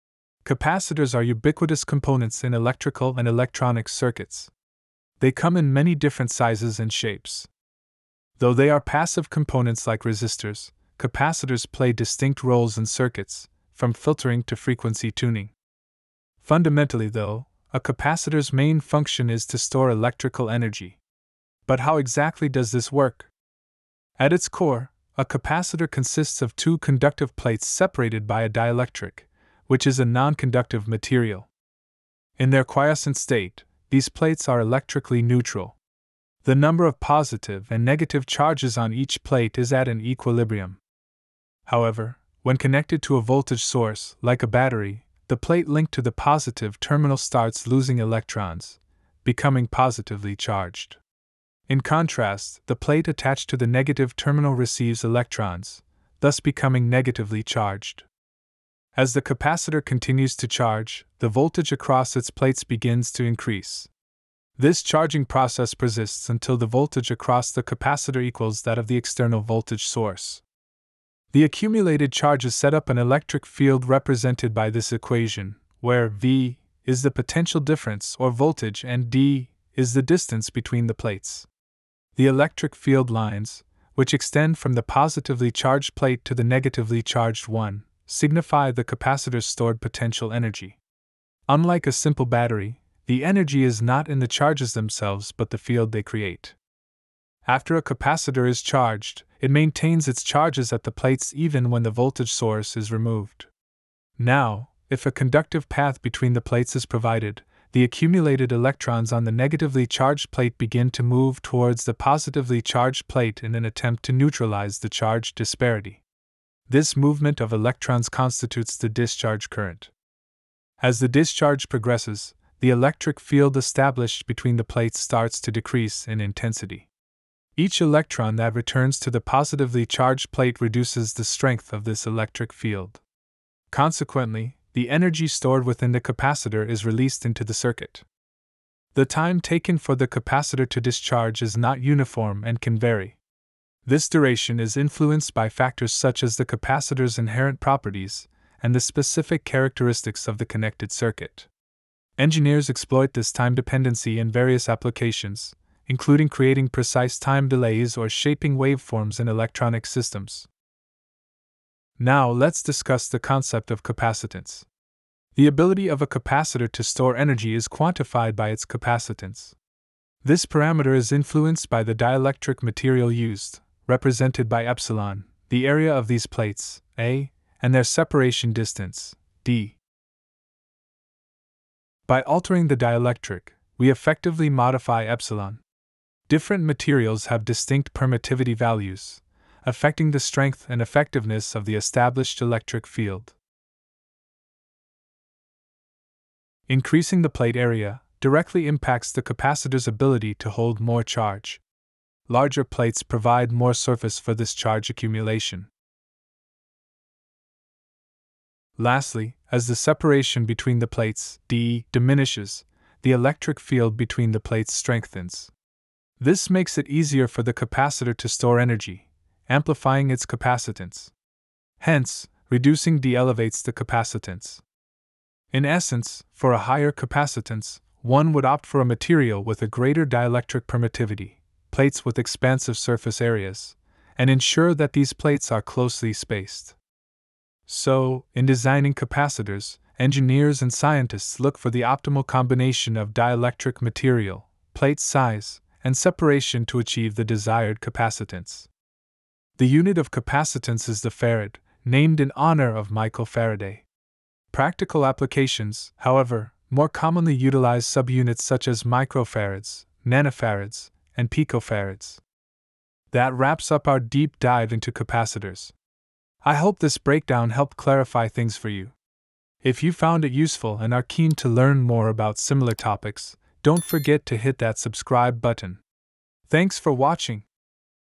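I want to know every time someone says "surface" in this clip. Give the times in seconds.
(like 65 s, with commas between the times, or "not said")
203 s, 232 s.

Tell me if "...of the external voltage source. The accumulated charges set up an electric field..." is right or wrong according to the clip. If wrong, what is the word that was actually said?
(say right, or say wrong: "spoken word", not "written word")
right.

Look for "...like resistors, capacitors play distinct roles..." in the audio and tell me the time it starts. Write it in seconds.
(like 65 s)
9 s.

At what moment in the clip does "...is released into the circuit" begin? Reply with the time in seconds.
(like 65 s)
136 s.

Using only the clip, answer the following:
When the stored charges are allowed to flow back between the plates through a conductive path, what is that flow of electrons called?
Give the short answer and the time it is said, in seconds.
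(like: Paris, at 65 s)
discharge current, at 118 s.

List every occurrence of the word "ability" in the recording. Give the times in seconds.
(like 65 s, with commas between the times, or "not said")
165 s, 199 s.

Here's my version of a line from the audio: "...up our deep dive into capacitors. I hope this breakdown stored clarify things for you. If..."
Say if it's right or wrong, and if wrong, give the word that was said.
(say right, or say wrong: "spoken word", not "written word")
wrong: "helped", not "stored".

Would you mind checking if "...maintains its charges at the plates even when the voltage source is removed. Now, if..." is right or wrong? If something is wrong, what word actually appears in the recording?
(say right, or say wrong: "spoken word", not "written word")
right.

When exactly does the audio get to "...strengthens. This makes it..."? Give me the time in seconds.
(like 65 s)
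214 s.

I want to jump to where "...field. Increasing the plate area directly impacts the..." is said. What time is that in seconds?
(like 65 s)
192 s.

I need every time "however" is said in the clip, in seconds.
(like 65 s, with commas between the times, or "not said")
41 s, 255 s.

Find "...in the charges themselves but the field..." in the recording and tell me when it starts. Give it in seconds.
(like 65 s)
94 s.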